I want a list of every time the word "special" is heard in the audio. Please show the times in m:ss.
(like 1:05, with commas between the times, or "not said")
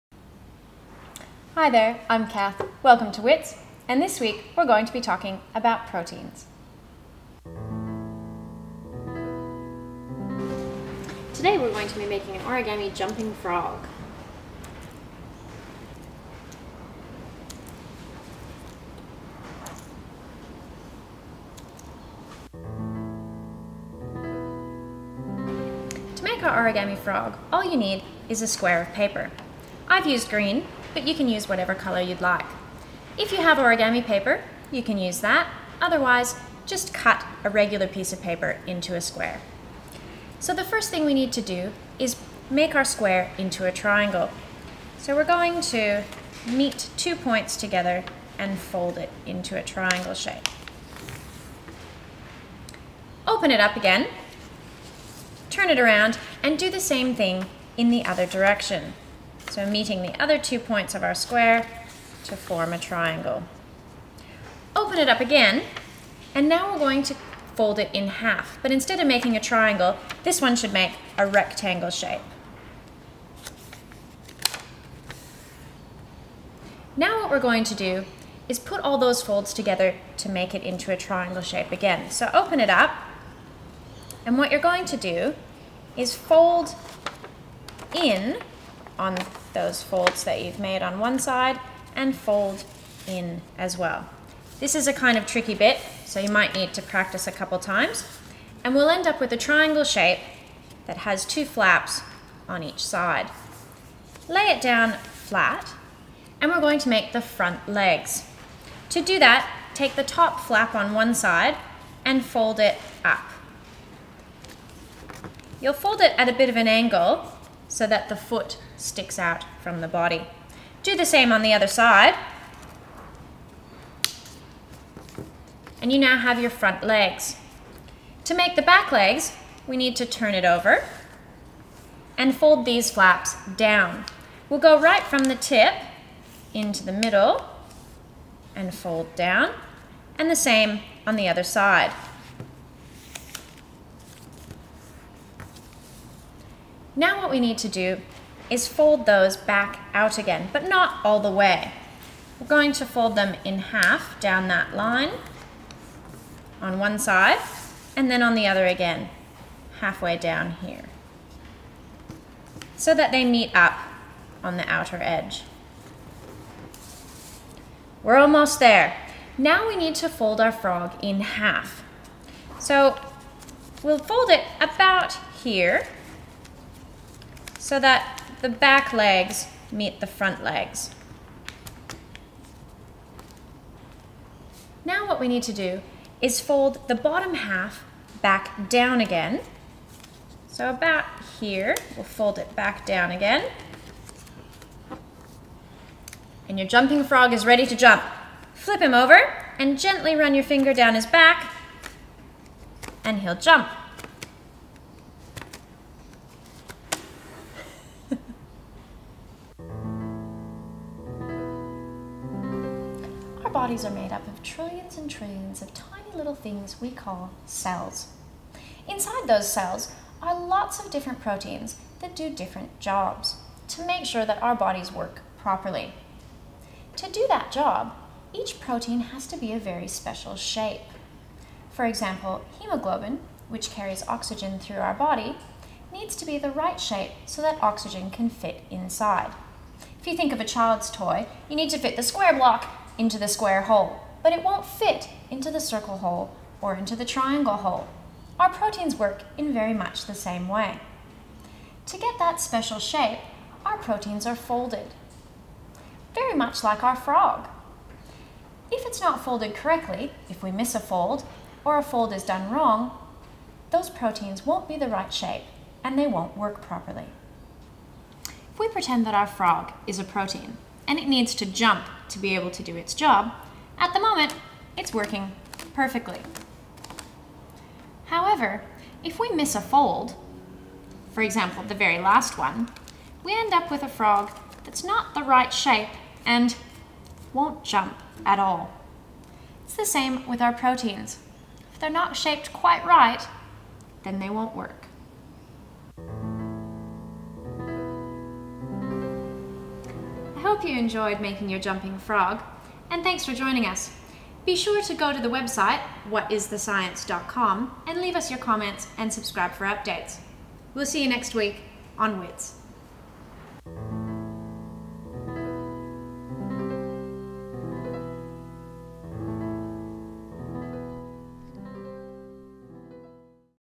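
3:49, 4:12.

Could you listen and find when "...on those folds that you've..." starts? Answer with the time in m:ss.
1:29.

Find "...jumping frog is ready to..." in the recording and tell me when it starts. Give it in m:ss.
3:16.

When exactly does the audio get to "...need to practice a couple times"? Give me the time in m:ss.
1:36.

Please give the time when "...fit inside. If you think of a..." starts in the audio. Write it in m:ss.
3:58.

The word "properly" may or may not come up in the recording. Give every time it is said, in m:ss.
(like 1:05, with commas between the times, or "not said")
3:45, 4:26.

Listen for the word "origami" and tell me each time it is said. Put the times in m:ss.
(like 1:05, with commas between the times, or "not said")
0:12, 0:26, 0:33.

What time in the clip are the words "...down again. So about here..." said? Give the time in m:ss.
3:08.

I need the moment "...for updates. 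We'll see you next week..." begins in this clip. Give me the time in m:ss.
5:09.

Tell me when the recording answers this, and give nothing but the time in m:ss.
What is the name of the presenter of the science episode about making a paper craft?
0:02.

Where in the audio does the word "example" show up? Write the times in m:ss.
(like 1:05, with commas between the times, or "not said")
3:51, 4:41.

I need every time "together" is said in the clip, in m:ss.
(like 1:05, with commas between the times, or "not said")
0:47, 1:19.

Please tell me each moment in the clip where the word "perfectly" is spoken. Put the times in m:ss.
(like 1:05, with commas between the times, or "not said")
4:35.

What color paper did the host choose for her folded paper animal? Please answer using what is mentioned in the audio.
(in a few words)
Green.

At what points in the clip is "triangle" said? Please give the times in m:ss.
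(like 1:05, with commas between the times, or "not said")
0:43, 0:49, 1:02, 1:09, 1:20, 1:39, 4:07.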